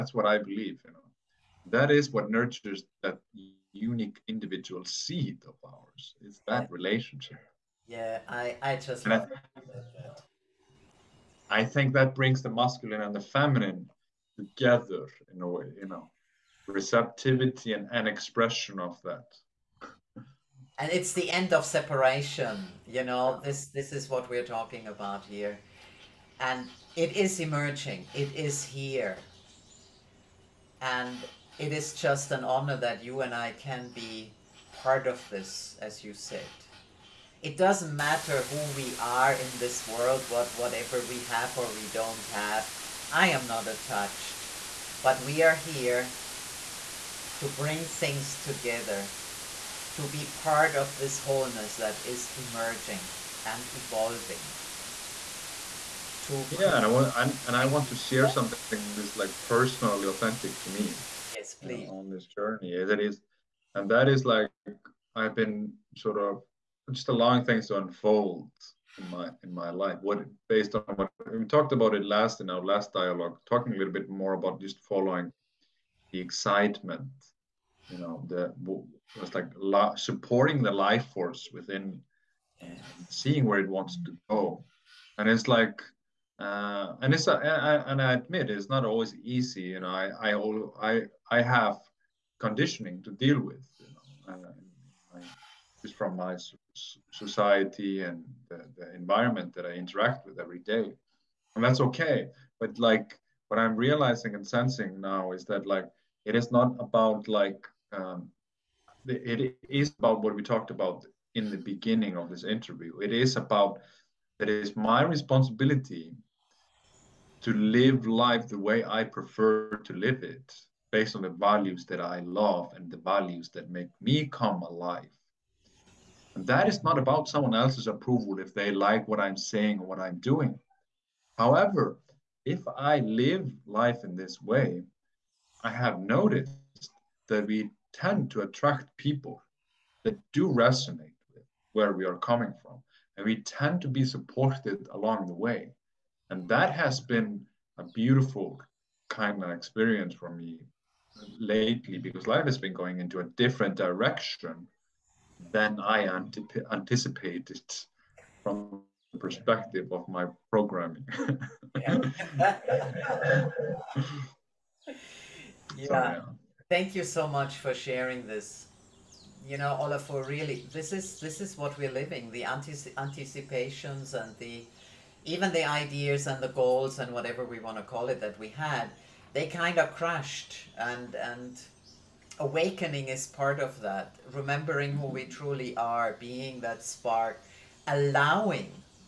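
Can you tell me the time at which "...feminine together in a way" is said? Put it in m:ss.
0:13.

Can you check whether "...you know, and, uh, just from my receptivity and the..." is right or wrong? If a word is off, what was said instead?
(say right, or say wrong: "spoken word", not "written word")
wrong: "society", not "receptivity".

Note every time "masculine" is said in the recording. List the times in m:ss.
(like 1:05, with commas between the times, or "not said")
0:12.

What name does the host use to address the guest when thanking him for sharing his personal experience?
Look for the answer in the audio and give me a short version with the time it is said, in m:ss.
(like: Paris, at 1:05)
Olafur, at 2:49.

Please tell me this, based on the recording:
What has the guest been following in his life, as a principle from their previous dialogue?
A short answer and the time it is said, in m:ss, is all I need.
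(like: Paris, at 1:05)
the excitement, at 1:16.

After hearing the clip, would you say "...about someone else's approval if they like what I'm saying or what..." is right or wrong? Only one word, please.
right.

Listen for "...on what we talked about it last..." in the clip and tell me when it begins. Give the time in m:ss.
1:10.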